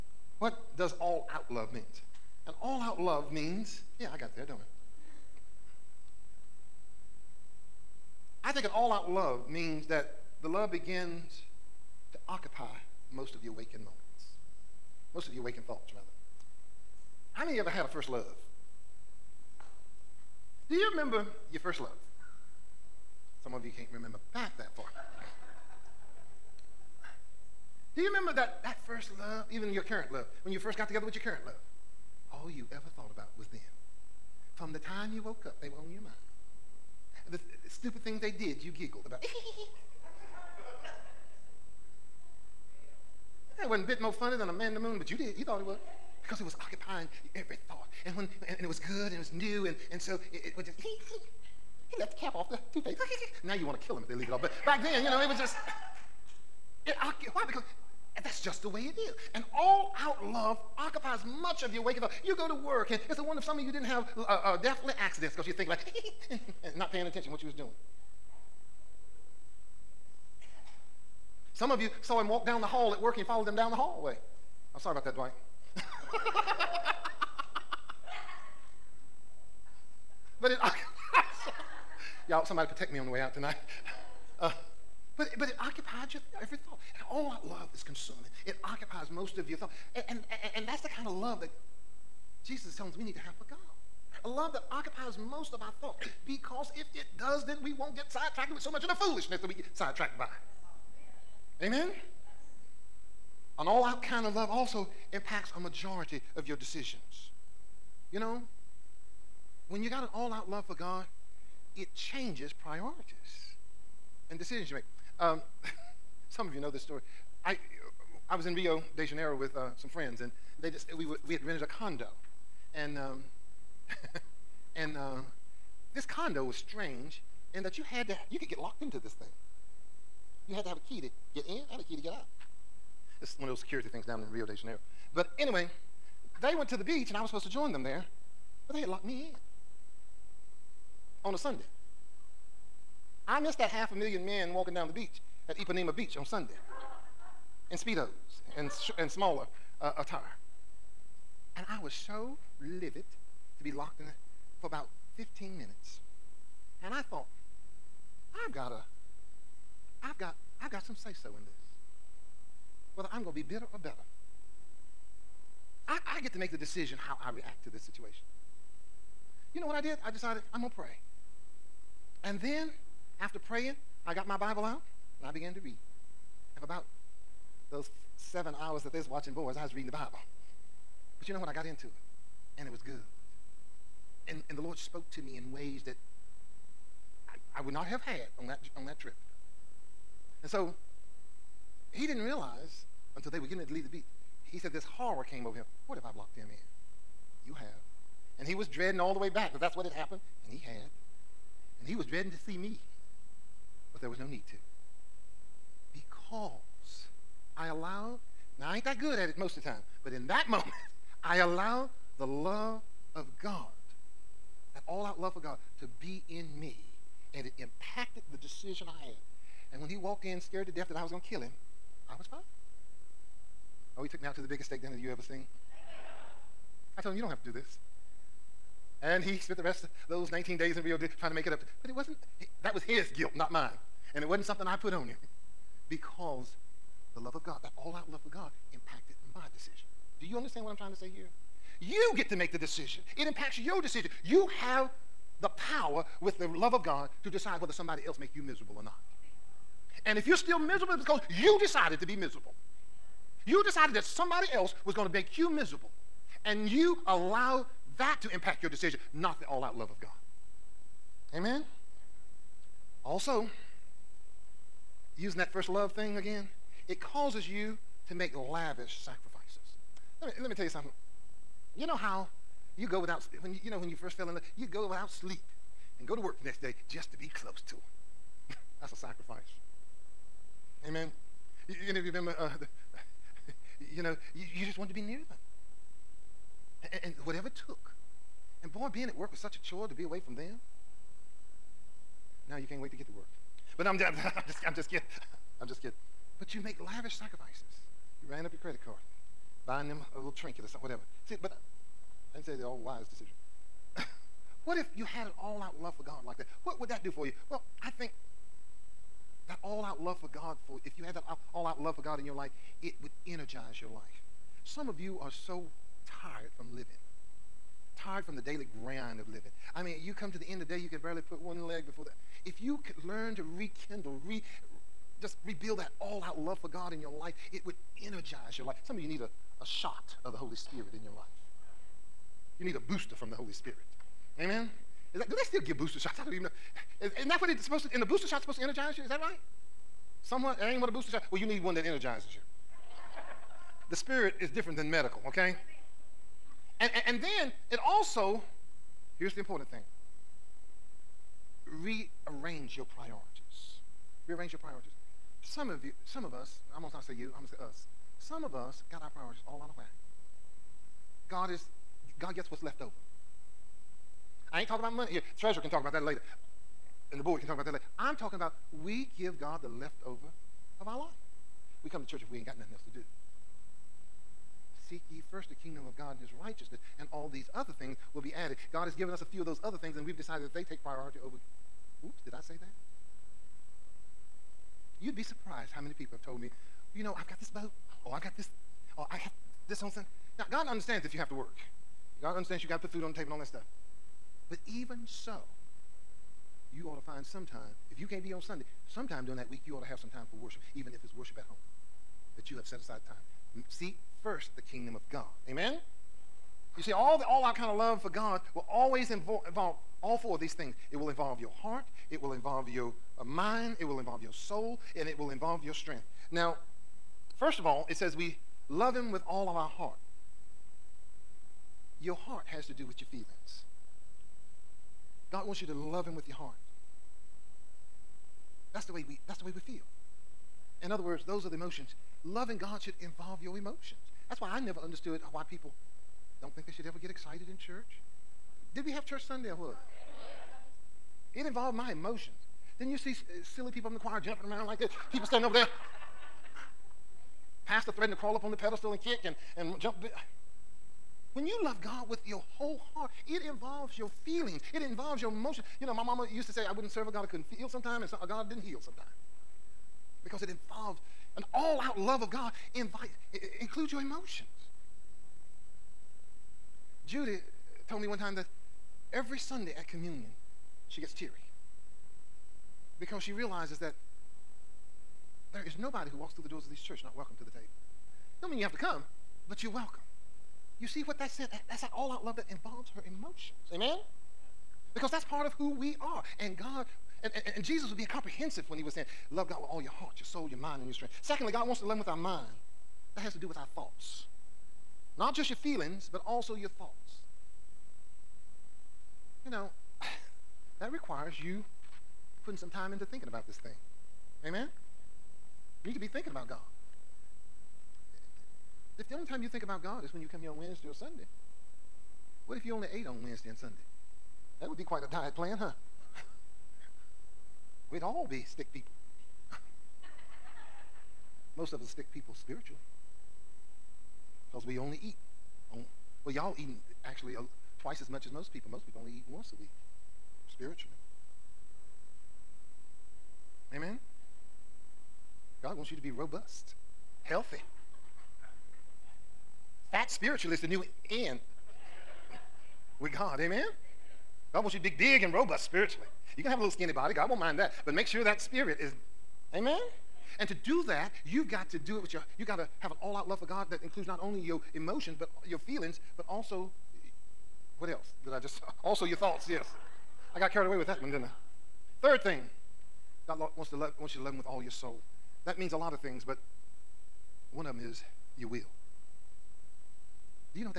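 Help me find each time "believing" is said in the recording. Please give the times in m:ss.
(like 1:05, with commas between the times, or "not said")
not said.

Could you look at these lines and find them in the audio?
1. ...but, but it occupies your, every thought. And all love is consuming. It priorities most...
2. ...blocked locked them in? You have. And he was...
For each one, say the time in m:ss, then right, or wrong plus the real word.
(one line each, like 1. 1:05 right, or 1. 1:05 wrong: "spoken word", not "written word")
1. 1:25 wrong: "occupies", not "priorities"
2. 3:16 right.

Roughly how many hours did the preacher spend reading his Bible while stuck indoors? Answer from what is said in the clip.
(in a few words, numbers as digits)
7.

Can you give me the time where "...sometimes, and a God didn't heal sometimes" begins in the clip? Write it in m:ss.
7:37.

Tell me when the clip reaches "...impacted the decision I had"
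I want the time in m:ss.
3:37.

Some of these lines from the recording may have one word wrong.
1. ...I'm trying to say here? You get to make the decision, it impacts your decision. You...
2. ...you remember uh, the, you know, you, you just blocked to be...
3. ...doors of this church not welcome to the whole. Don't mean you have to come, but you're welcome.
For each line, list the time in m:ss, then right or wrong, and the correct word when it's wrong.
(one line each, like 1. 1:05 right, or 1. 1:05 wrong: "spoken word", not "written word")
1. 4:00 right
2. 4:42 wrong: "wanted", not "blocked"
3. 7:56 wrong: "table", not "whole".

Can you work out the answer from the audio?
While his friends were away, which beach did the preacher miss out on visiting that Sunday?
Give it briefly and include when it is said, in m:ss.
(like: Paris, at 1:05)
Ipanema Beach, at 2:25.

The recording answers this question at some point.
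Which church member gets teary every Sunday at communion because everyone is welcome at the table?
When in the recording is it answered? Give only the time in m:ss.
7:47.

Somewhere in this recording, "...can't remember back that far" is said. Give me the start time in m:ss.
0:23.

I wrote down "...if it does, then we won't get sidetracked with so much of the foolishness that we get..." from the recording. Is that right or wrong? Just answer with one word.
right.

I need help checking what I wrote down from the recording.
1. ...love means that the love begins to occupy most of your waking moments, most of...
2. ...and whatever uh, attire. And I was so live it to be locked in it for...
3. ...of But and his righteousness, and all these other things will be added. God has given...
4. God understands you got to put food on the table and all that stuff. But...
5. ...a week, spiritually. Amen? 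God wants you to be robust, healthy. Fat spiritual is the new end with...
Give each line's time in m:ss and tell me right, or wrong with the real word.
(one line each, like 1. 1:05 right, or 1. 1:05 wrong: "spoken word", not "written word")
1. 0:09 right
2. 2:28 wrong: "smaller", not "whatever"
3. 6:15 wrong: "God", not "But"
4. 6:32 right
5. 8:49 right.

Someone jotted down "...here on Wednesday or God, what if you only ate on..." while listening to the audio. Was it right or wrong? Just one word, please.
wrong.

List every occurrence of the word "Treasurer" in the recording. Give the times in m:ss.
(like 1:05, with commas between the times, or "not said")
6:05.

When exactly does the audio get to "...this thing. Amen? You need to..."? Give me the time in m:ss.
8:23.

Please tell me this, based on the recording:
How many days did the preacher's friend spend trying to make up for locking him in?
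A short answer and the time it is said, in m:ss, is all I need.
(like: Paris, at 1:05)
19, at 3:50.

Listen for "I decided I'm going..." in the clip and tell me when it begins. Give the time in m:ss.
2:50.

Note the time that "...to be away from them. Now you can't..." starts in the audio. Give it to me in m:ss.
4:49.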